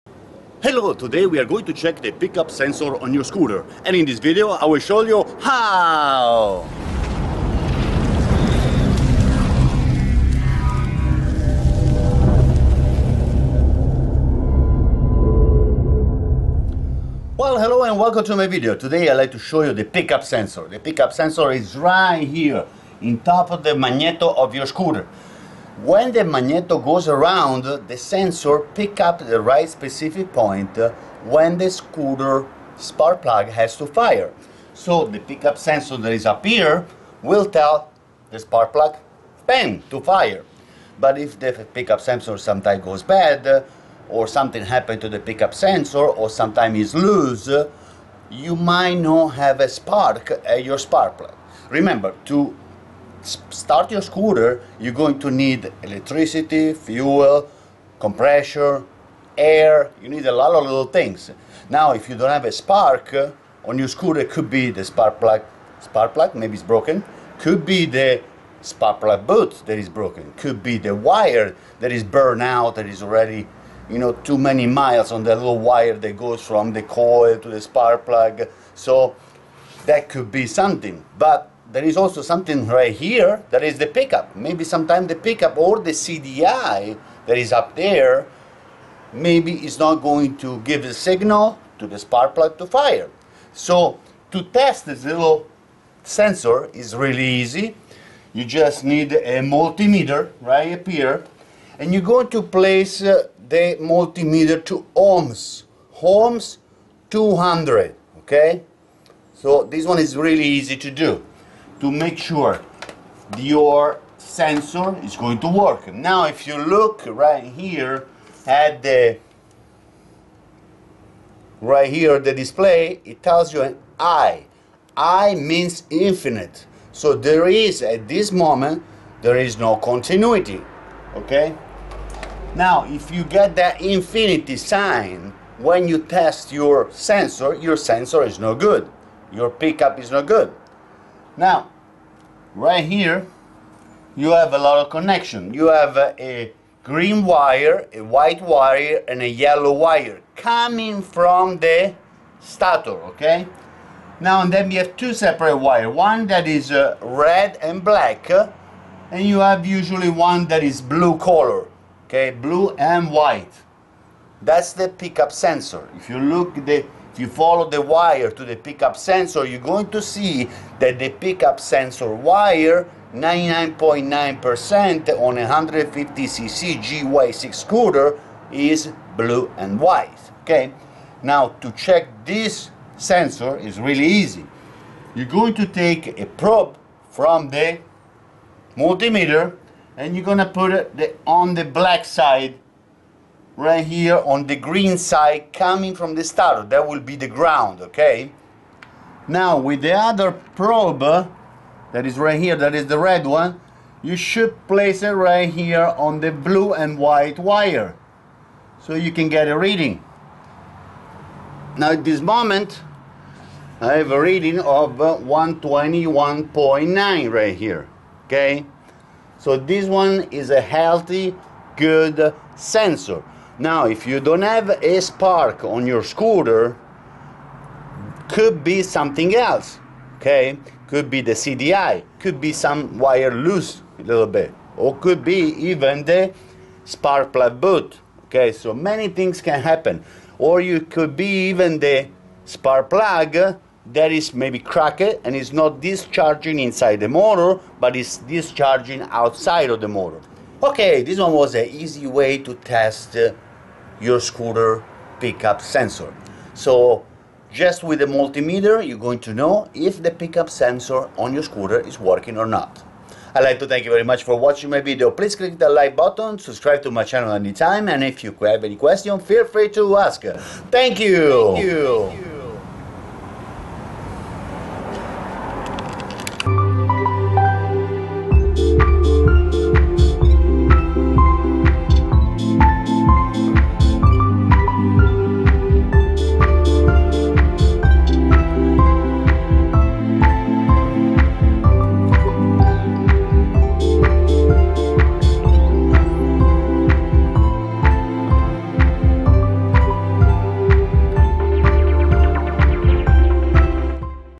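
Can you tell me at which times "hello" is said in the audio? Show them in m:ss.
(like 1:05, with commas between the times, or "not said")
0:00, 0:17.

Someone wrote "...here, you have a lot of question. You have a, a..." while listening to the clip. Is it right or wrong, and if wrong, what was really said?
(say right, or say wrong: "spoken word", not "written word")
wrong: "connection", not "question".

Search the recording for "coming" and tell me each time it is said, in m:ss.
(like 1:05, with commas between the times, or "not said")
2:30, 3:15.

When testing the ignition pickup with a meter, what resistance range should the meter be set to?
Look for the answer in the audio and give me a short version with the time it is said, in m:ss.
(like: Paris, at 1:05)
Ohms 200, at 1:46.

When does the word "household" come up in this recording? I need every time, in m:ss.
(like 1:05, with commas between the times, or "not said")
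not said.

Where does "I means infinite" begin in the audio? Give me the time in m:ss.
2:04.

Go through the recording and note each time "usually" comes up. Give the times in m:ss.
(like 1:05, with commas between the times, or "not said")
2:39.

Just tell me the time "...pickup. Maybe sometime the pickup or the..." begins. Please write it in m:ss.
1:23.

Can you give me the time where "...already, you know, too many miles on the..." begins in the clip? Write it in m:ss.
1:13.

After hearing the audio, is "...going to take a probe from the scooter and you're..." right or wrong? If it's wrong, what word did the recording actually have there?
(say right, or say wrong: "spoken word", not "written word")
wrong: "multimeter", not "scooter".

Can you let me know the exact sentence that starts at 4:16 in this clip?
So just with the multimeter, you're going to know if the pickup sensor on your scooter is working or not.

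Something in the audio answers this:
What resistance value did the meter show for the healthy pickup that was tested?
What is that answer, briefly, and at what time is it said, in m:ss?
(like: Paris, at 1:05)
121.9, at 3:34.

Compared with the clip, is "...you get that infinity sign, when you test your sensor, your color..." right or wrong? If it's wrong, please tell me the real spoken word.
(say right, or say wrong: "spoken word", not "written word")
wrong: "sensor", not "color".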